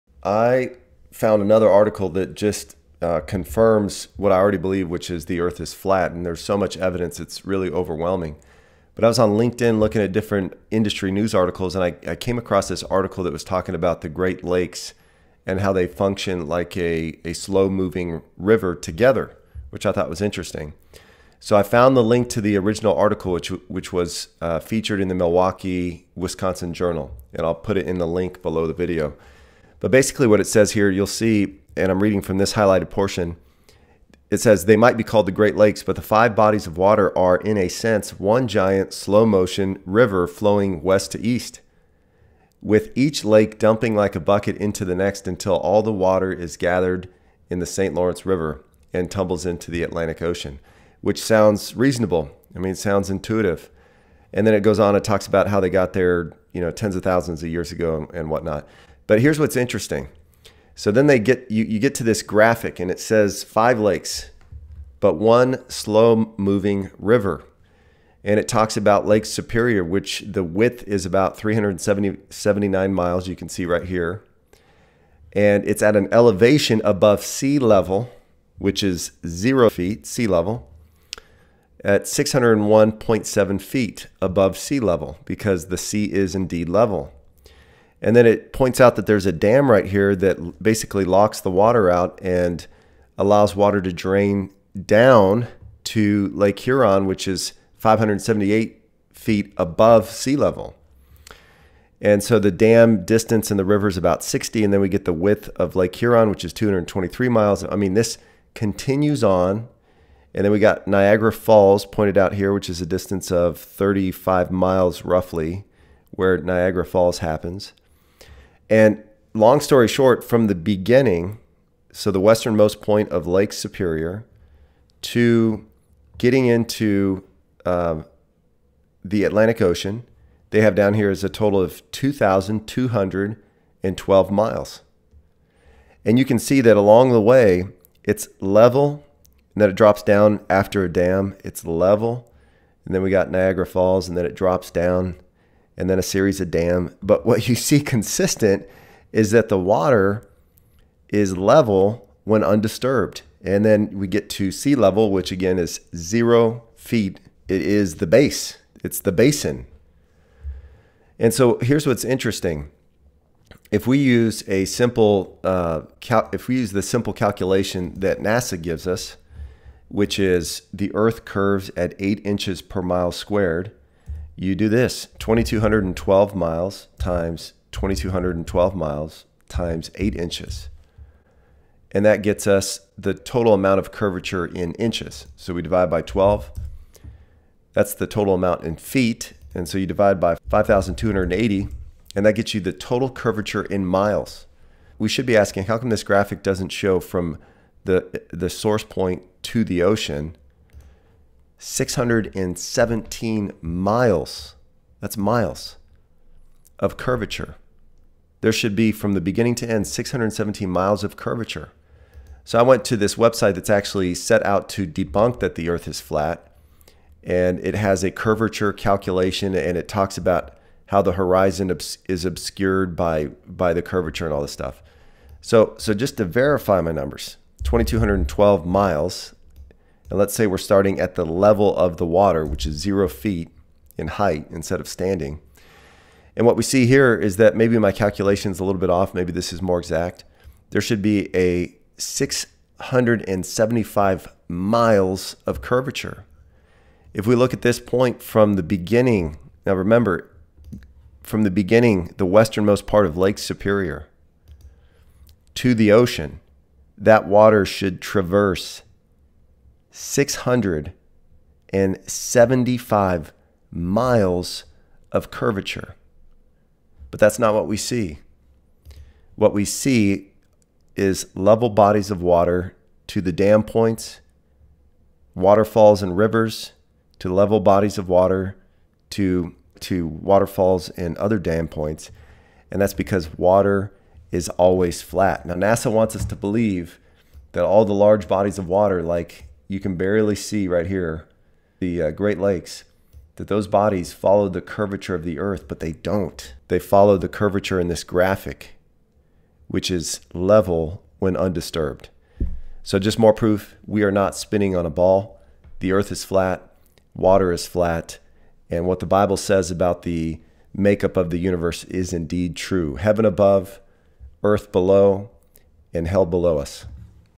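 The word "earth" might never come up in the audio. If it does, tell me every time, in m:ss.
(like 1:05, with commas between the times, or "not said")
0:05, 2:50, 3:35, 4:55, 5:05, 5:14.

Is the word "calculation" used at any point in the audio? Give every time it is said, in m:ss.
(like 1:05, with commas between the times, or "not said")
2:47, 3:38, 3:57.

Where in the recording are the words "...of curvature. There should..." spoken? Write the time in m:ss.
3:26.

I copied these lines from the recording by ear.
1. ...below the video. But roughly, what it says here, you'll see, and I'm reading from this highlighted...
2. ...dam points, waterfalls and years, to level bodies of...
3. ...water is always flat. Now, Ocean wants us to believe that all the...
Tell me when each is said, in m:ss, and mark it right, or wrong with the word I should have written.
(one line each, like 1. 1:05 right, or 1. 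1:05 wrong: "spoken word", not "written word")
1. 0:28 wrong: "basically", not "roughly"
2. 4:33 wrong: "rivers", not "years"
3. 4:43 wrong: "NASA", not "Ocean".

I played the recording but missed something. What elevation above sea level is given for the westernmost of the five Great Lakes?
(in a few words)
601.7 feet.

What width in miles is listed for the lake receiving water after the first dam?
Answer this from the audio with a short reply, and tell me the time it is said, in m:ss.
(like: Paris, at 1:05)
223 miles, at 1:46.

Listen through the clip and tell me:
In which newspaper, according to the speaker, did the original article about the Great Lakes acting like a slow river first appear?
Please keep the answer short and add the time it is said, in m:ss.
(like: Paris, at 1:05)
Milwaukee, Wisconsin Journal, at 0:25.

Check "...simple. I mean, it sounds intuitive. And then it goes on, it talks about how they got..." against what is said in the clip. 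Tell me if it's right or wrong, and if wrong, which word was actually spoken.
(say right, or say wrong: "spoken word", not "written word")
wrong: "reasonable", not "simple".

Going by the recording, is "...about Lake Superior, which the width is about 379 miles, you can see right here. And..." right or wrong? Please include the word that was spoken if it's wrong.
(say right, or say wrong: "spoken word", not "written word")
right.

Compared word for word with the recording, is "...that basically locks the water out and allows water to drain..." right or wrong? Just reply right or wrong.
right.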